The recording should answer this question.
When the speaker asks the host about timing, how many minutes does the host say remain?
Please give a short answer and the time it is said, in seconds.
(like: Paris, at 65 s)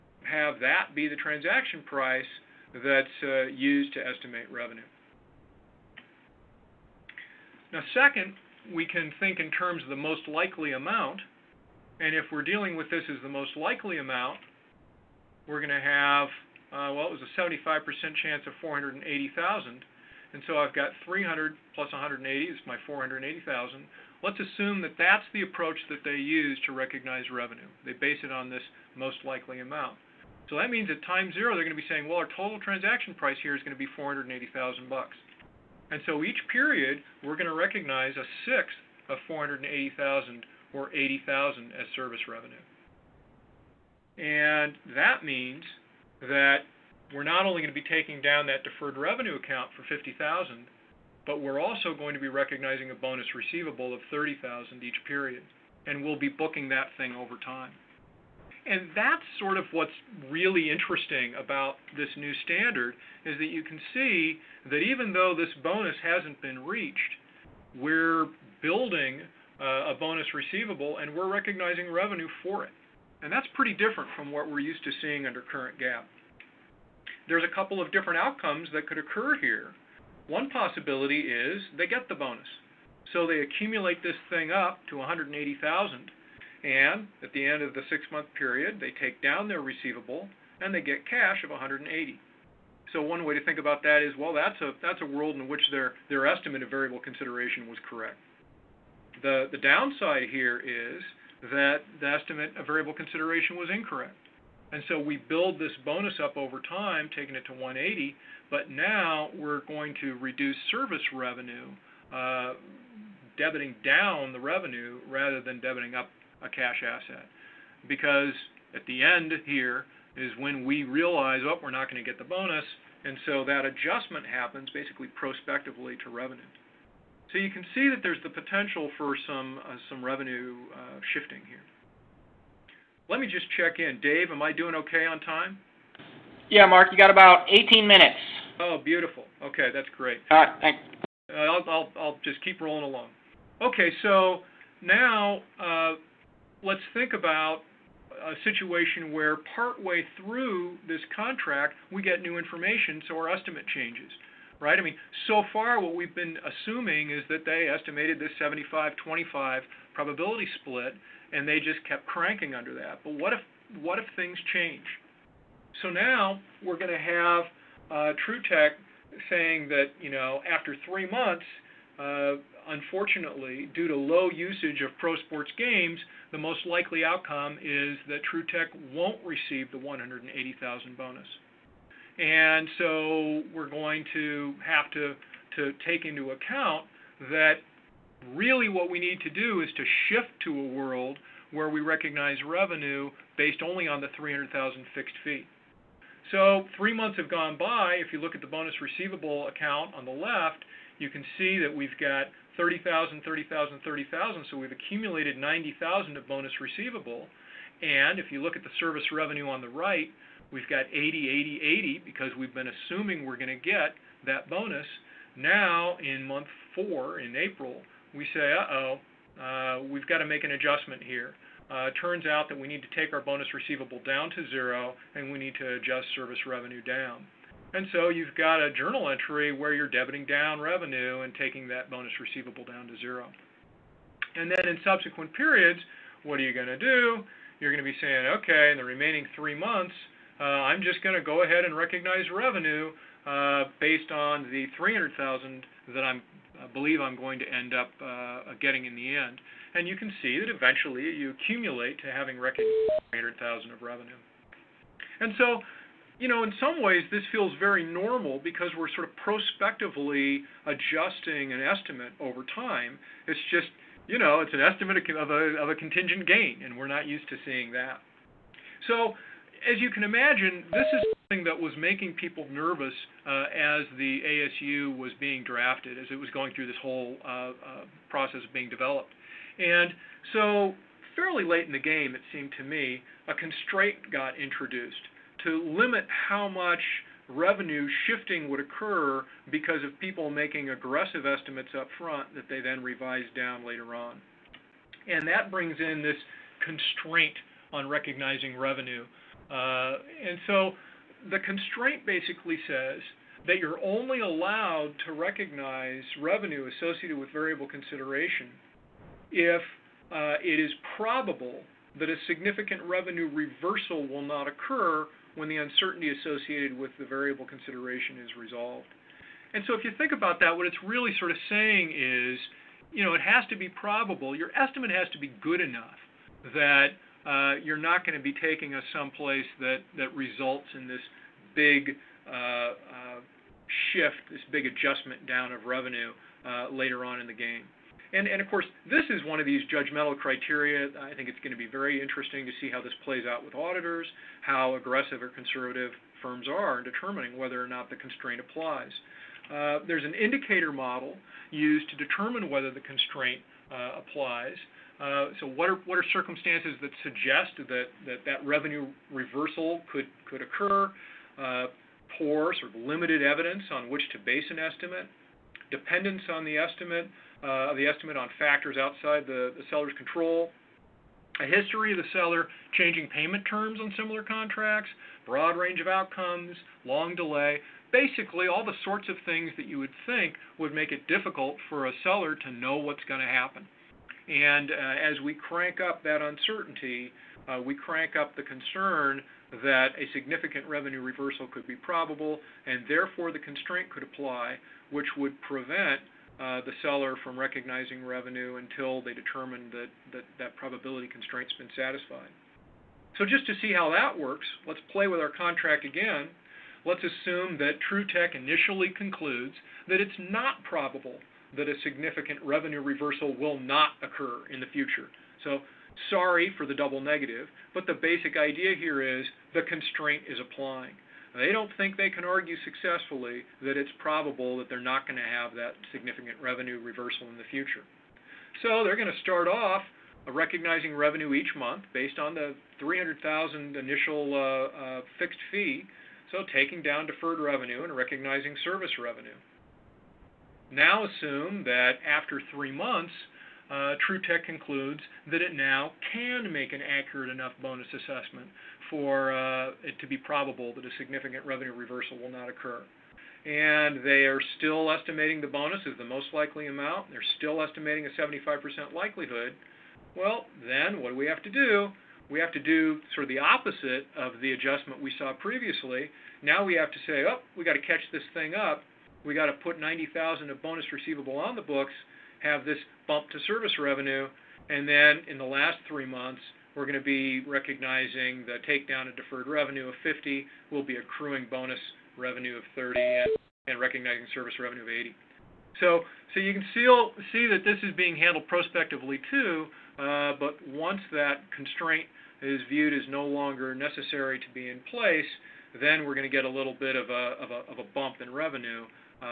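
18 minutes, at 137 s.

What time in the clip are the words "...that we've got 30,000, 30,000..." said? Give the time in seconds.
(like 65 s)
201 s.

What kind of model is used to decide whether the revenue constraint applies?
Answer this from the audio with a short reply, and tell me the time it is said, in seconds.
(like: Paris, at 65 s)
indicator model, at 350 s.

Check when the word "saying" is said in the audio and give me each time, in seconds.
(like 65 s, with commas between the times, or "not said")
31 s, 169 s, 237 s, 321 s.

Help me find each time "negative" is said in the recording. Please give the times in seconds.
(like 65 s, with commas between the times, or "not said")
417 s.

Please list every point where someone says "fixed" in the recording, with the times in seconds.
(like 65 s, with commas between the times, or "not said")
194 s, 435 s.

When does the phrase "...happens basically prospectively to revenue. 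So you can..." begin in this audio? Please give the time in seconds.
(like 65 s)
124 s.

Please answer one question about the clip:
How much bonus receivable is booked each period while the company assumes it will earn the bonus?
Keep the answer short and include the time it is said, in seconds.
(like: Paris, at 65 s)
30,000, at 52 s.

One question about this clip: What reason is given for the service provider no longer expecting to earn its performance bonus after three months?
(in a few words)
low usage of pro sports games.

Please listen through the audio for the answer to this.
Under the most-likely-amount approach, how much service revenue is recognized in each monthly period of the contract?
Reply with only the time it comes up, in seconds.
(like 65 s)
40 s.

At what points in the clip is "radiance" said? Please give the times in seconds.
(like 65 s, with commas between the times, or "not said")
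not said.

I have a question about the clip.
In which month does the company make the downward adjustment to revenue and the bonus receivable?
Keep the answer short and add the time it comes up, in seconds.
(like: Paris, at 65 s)
April, at 217 s.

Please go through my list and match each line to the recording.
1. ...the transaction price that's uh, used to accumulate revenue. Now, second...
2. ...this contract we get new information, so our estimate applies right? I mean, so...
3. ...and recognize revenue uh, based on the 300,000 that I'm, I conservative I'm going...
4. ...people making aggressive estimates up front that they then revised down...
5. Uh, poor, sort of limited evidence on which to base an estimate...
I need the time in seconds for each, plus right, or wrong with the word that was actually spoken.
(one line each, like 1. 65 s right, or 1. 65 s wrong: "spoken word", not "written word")
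1. 1 s wrong: "estimate", not "accumulate"
2. 150 s wrong: "changes", not "applies"
3. 241 s wrong: "believe", not "conservative"
4. 289 s right
5. 361 s right.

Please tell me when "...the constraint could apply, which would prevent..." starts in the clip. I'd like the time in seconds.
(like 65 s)
393 s.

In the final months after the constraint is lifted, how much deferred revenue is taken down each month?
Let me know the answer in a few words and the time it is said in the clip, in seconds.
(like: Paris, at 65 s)
50, at 479 s.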